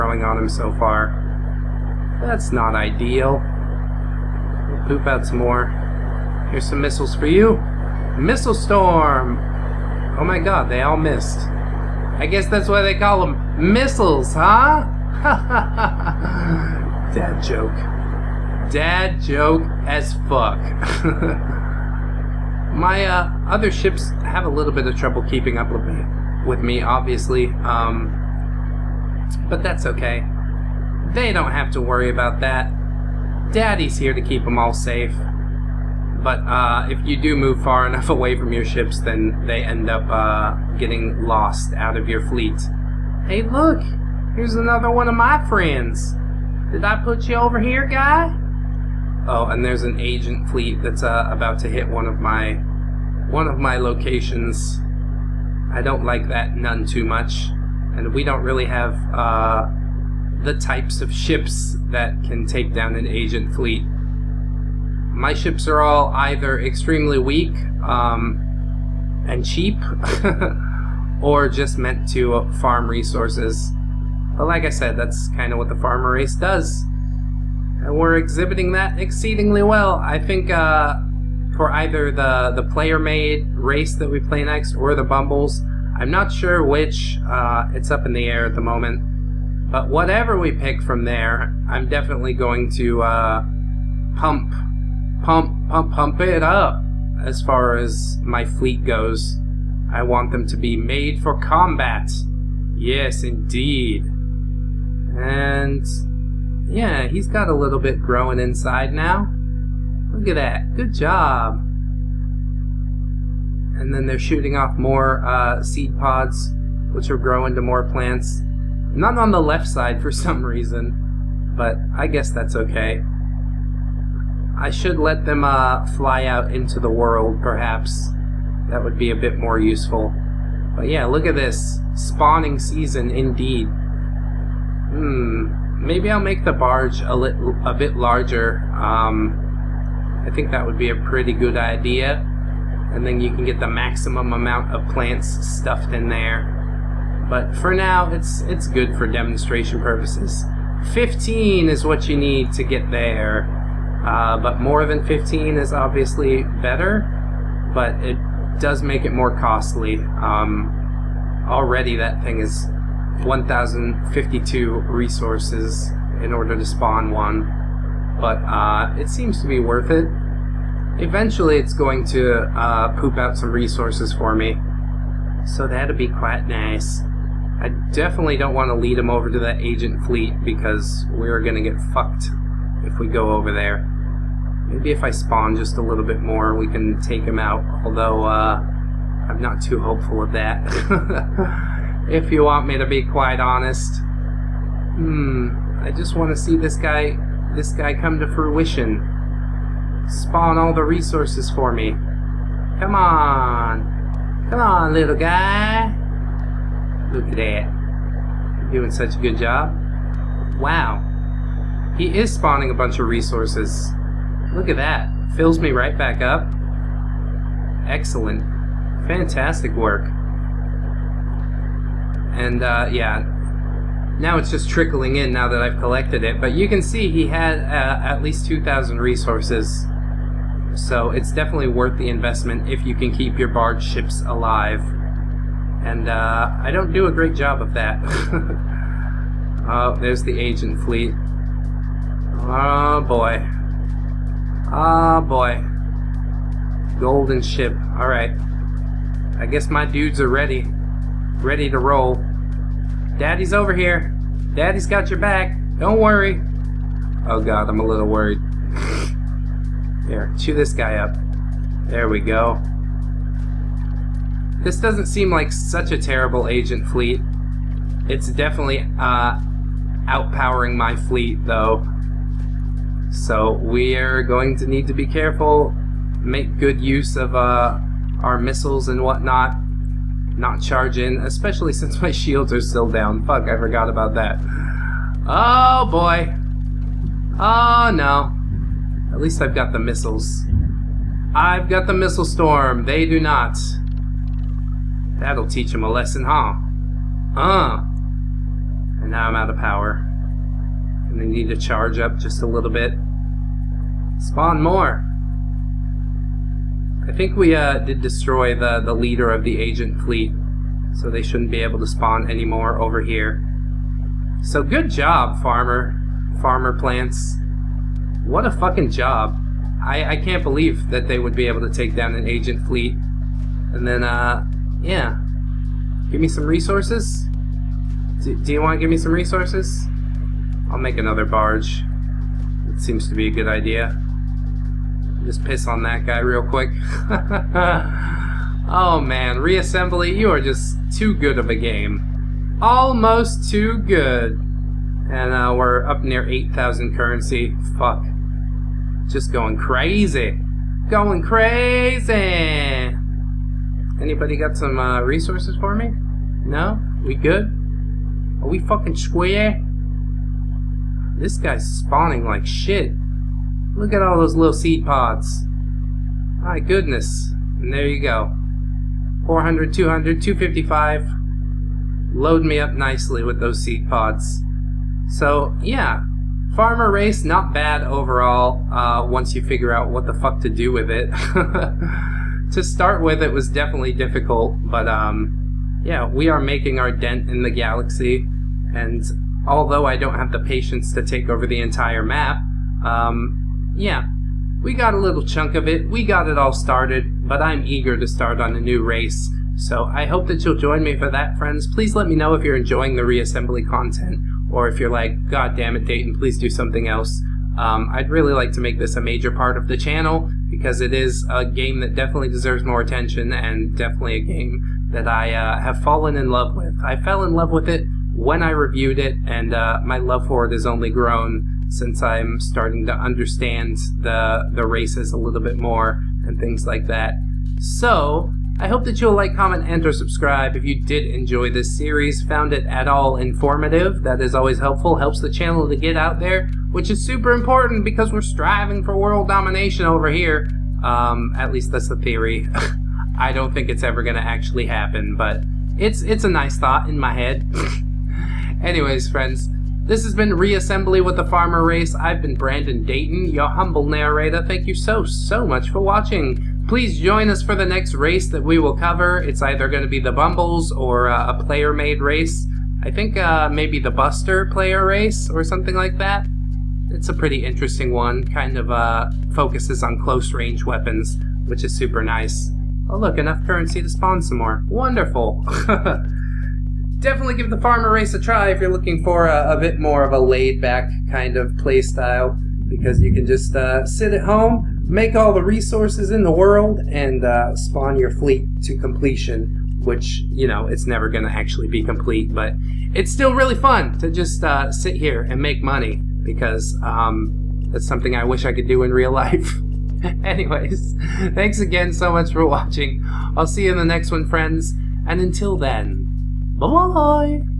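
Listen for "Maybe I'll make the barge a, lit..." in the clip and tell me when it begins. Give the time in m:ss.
2:15.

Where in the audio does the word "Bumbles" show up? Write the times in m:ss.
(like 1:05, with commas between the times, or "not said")
1:25, 7:40.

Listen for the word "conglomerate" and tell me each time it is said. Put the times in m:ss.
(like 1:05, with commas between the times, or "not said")
not said.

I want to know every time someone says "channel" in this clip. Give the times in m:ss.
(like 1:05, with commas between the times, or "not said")
6:49, 7:15.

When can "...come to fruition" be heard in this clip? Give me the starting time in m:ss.
3:17.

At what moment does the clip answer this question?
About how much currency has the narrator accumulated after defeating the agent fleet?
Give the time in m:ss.
5:46.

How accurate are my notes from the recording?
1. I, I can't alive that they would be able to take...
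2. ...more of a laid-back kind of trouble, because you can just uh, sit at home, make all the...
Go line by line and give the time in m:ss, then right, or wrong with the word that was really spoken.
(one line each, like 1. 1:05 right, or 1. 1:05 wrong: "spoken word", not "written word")
1. 5:19 wrong: "believe", not "alive"
2. 7:59 wrong: "playstyle", not "trouble".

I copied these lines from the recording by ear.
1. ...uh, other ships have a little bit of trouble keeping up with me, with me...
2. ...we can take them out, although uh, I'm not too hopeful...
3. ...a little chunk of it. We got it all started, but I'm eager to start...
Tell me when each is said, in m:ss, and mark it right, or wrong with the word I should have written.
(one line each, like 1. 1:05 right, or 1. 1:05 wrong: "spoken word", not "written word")
1. 0:23 right
2. 3:06 right
3. 6:34 right.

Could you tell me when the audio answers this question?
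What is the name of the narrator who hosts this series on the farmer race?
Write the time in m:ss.
7:32.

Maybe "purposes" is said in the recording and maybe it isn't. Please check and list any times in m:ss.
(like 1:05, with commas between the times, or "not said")
2:29.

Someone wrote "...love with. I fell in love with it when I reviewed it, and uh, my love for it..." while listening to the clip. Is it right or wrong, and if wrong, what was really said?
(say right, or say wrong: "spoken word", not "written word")
right.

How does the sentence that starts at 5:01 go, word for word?
And I need to charge up just a little bit.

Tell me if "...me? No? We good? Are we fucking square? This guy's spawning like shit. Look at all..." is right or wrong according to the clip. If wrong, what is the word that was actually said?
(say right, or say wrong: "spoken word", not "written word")
right.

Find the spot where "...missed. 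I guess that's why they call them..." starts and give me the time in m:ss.
0:10.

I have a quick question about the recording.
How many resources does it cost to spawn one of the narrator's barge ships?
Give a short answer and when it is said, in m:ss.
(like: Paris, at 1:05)
1,052, at 2:43.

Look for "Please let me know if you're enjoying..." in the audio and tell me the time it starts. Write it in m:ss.
6:41.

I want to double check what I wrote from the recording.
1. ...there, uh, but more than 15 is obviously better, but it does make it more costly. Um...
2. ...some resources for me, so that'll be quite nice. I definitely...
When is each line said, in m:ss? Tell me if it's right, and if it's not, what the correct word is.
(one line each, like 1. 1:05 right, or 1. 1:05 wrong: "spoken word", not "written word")
1. 2:32 right
2. 2:53 right.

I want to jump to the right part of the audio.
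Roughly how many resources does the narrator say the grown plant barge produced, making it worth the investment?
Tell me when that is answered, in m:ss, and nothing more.
3:48.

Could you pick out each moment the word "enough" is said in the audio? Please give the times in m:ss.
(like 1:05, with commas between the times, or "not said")
0:37, 7:53.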